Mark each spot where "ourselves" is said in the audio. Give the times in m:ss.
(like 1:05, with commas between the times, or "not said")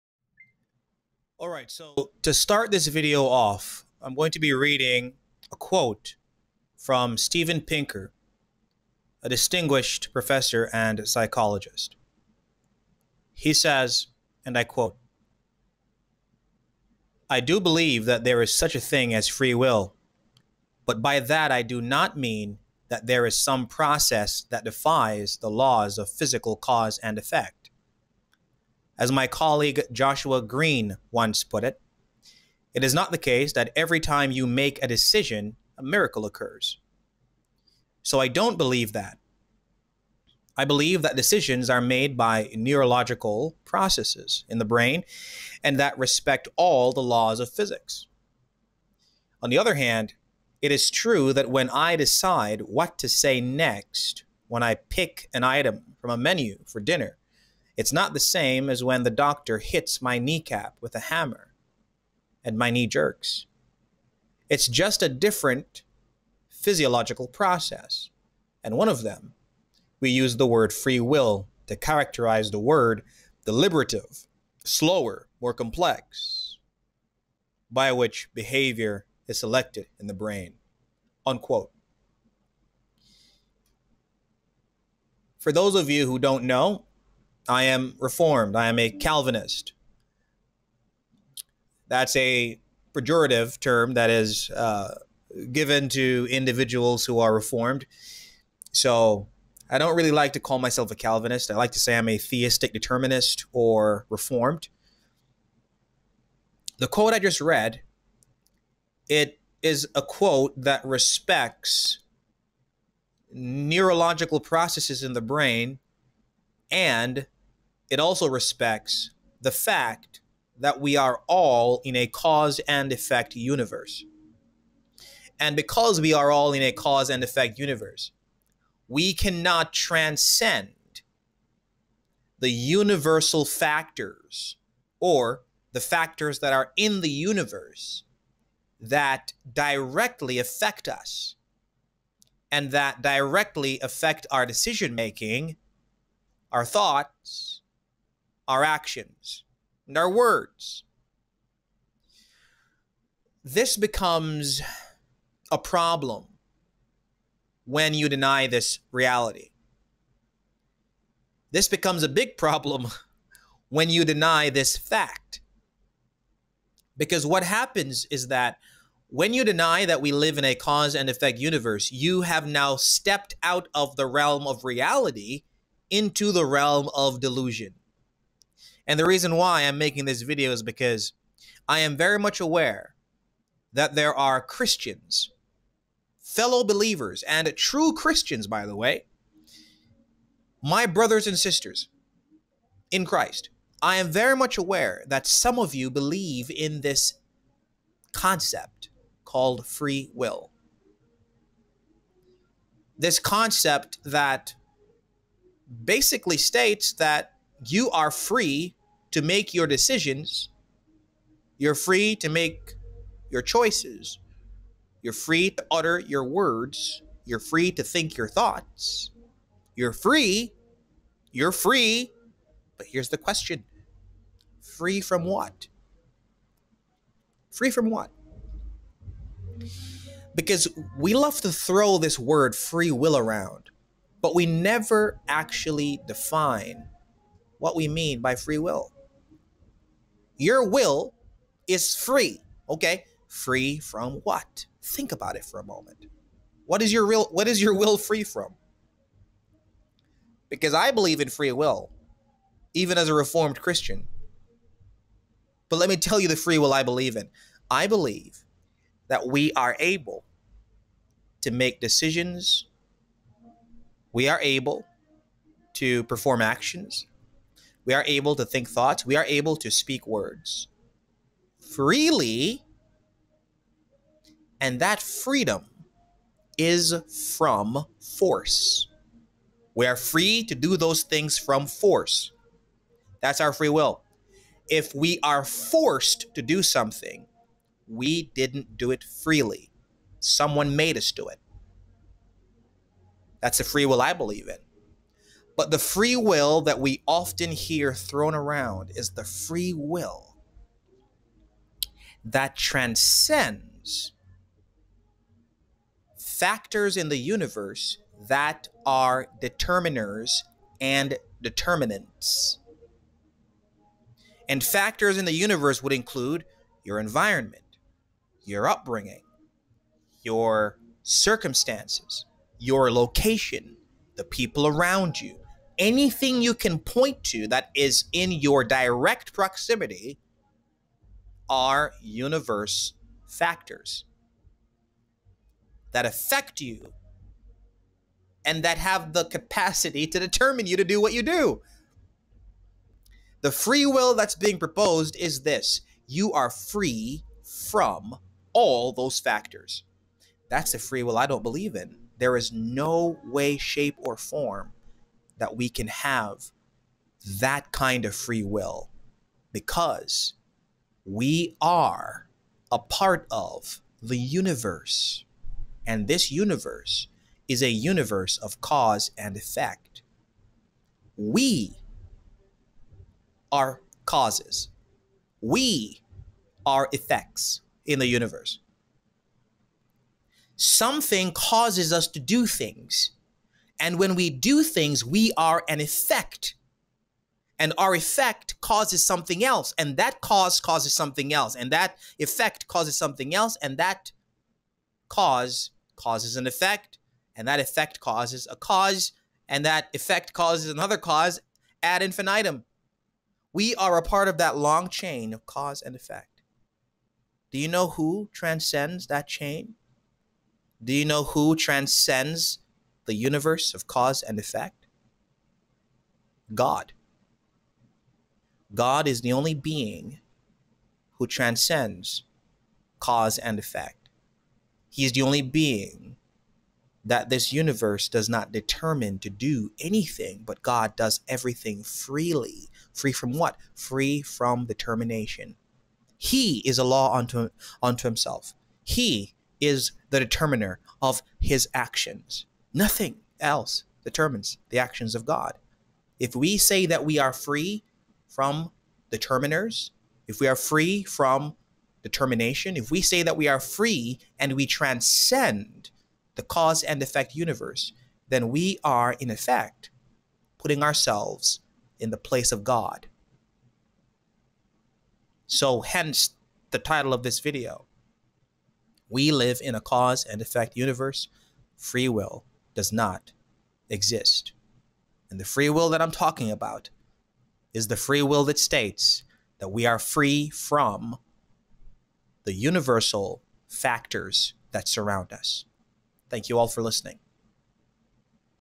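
7:40.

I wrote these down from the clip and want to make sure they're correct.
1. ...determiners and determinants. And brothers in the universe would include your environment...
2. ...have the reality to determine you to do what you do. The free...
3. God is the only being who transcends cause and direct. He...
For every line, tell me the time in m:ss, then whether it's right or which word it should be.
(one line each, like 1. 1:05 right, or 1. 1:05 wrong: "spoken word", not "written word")
1. 5:09 wrong: "factors", not "brothers"
2. 5:38 wrong: "capacity", not "reality"
3. 6:58 wrong: "effect", not "direct".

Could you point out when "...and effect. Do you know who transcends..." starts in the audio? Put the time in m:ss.
6:45.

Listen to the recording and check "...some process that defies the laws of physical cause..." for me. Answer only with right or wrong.
right.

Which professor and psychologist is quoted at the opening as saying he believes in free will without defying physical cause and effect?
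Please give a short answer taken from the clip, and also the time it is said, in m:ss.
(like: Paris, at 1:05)
Steven Pinker, at 0:07.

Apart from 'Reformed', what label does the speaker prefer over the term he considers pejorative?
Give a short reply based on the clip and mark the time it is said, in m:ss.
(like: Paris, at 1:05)
theistic determinist, at 1:42.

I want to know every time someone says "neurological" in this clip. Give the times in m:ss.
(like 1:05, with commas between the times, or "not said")
0:42, 1:53.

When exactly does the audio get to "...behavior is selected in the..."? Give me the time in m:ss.
1:18.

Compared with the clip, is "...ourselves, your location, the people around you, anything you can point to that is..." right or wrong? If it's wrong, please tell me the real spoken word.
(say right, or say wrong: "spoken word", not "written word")
wrong: "circumstances", not "ourselves".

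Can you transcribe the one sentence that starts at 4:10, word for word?
Because I believe in free will, even as a reformed Christian.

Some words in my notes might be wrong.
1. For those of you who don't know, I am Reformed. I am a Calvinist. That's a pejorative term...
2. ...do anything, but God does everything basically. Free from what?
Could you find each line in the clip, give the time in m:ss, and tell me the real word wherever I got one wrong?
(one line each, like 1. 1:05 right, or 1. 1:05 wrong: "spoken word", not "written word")
1. 1:25 right
2. 7:09 wrong: "freely", not "basically".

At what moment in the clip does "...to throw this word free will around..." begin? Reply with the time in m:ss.
3:51.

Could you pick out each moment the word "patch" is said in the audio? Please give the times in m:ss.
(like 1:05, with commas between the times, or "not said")
not said.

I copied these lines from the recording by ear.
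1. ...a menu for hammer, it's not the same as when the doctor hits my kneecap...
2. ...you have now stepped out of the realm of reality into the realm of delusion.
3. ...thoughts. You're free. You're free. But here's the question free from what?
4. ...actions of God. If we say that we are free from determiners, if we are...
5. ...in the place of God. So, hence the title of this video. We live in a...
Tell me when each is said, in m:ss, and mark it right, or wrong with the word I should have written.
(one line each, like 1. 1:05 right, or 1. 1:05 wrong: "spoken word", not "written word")
1. 0:56 wrong: "dinner", not "hammer"
2. 2:51 right
3. 3:38 right
4. 7:24 right
5. 7:41 right.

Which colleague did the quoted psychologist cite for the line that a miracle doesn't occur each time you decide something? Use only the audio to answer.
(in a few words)
Joshua Greene.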